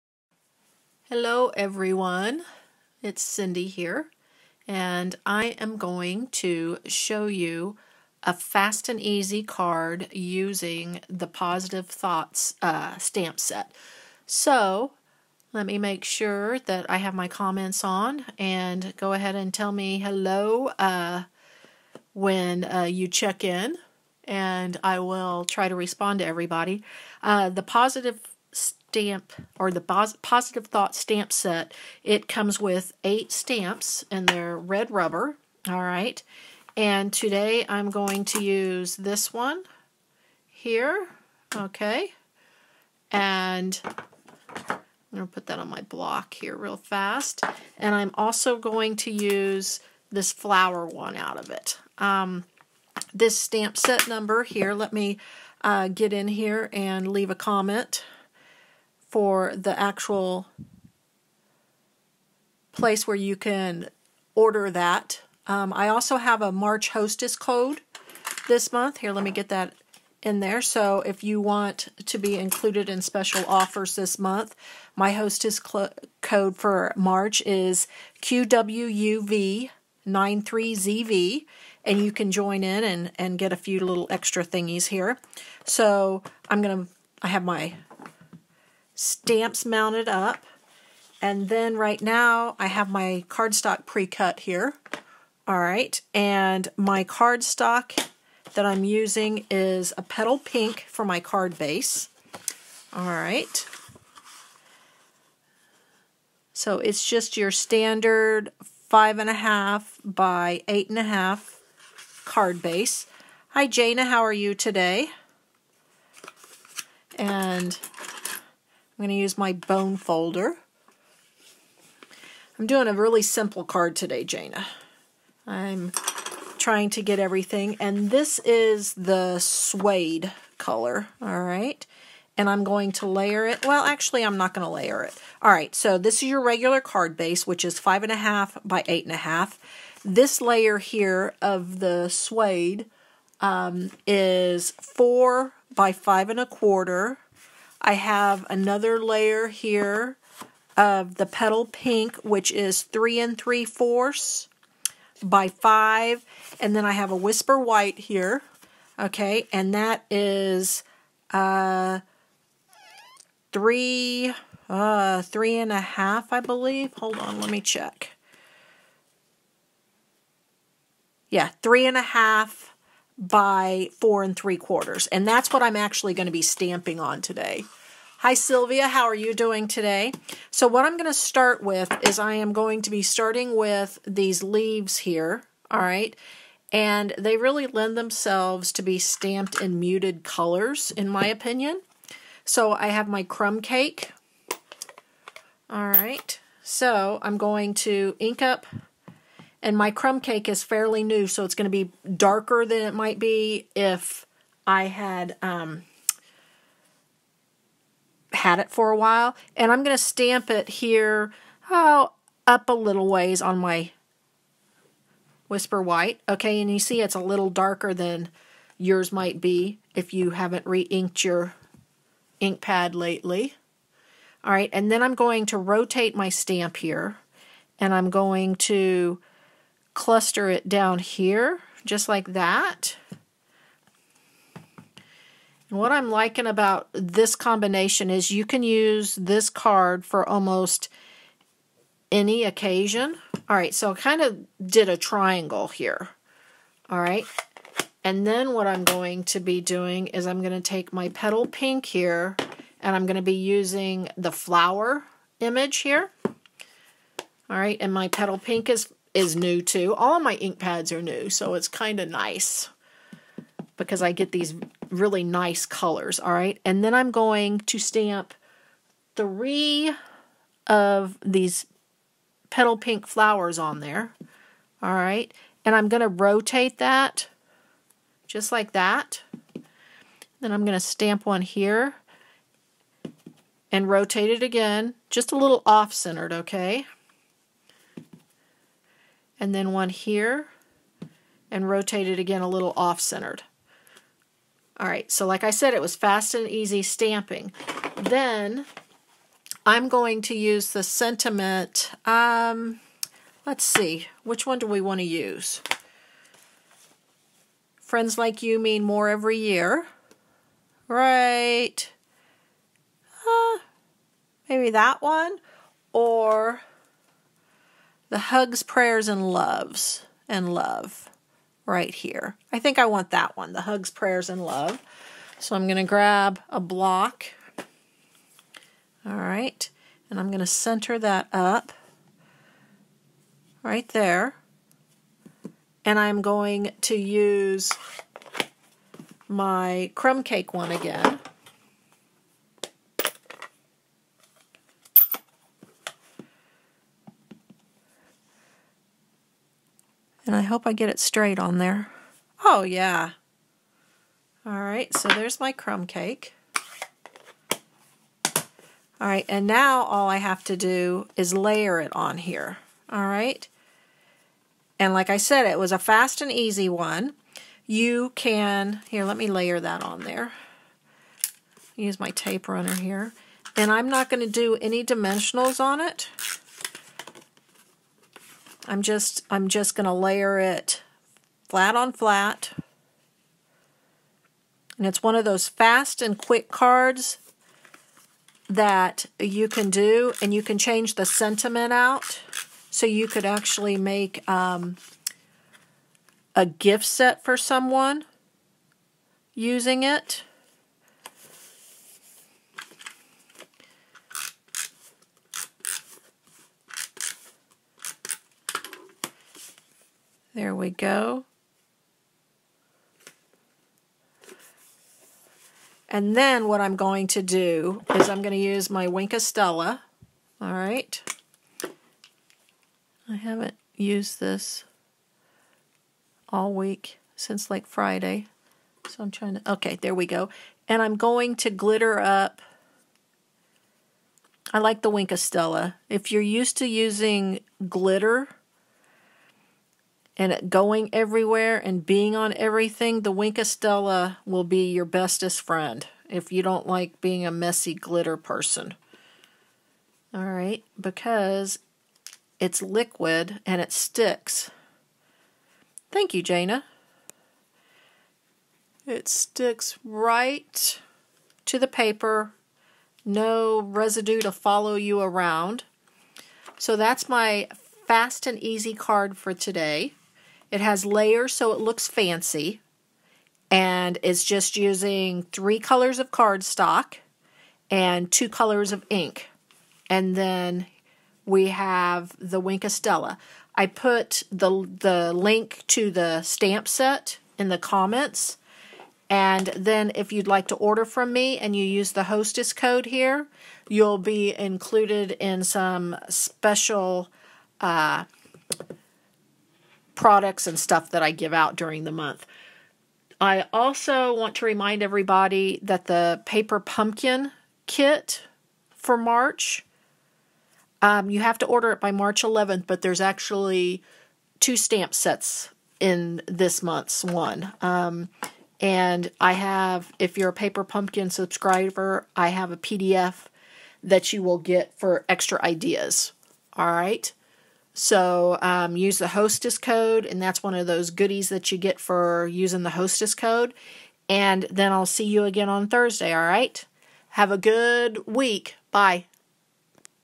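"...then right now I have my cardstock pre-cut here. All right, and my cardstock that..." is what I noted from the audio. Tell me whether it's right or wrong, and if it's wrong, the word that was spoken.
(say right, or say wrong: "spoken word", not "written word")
right.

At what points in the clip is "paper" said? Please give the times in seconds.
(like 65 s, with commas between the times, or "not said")
461 s, 506 s, 520 s.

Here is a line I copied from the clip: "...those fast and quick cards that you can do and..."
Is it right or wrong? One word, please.
right.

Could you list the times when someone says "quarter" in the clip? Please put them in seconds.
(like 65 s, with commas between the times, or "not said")
146 s, 174 s.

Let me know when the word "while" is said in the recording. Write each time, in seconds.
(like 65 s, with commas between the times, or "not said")
208 s.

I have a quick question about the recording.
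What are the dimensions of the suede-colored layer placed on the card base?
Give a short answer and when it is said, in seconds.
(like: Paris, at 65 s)
4 by 5 1/4, at 144 s.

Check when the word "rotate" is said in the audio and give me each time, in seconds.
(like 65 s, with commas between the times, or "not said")
225 s, 276 s, 283 s, 291 s.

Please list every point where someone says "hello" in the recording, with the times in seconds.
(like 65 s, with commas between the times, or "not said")
1 s, 19 s.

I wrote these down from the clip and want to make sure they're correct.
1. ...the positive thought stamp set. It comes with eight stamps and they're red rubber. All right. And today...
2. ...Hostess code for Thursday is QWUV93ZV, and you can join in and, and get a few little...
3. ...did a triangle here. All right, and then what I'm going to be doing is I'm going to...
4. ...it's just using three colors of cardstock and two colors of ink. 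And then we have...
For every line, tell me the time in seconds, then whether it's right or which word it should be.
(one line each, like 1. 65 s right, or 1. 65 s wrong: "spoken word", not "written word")
1. 29 s right
2. 75 s wrong: "March", not "Thursday"
3. 244 s right
4. 474 s right.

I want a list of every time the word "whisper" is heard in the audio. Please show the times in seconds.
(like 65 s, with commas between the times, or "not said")
157 s, 215 s.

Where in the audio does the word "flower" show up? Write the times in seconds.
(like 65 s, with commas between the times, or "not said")
50 s, 254 s, 273 s.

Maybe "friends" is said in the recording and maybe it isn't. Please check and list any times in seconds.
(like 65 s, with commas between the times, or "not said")
307 s, 445 s.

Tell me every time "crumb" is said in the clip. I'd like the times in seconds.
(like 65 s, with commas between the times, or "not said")
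193 s, 199 s, 339 s, 355 s.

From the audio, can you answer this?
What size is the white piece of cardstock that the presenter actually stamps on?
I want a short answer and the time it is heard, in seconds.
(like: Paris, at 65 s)
3 1/2 by 4 3/4, at 171 s.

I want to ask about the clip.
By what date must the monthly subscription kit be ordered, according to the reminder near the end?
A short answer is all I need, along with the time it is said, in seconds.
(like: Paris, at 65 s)
March 11th, at 511 s.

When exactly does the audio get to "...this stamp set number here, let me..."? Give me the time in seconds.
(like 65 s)
53 s.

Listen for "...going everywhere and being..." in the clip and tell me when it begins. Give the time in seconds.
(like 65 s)
440 s.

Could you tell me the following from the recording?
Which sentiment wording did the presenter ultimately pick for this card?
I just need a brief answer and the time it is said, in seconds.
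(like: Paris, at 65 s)
hugs, prayers, and love, at 323 s.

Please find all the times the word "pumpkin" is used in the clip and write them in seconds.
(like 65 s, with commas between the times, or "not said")
506 s, 520 s.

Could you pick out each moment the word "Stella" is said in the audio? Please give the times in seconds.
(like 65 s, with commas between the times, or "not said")
419 s, 435 s, 443 s, 482 s.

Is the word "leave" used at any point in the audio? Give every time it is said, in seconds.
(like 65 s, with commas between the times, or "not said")
57 s, 184 s.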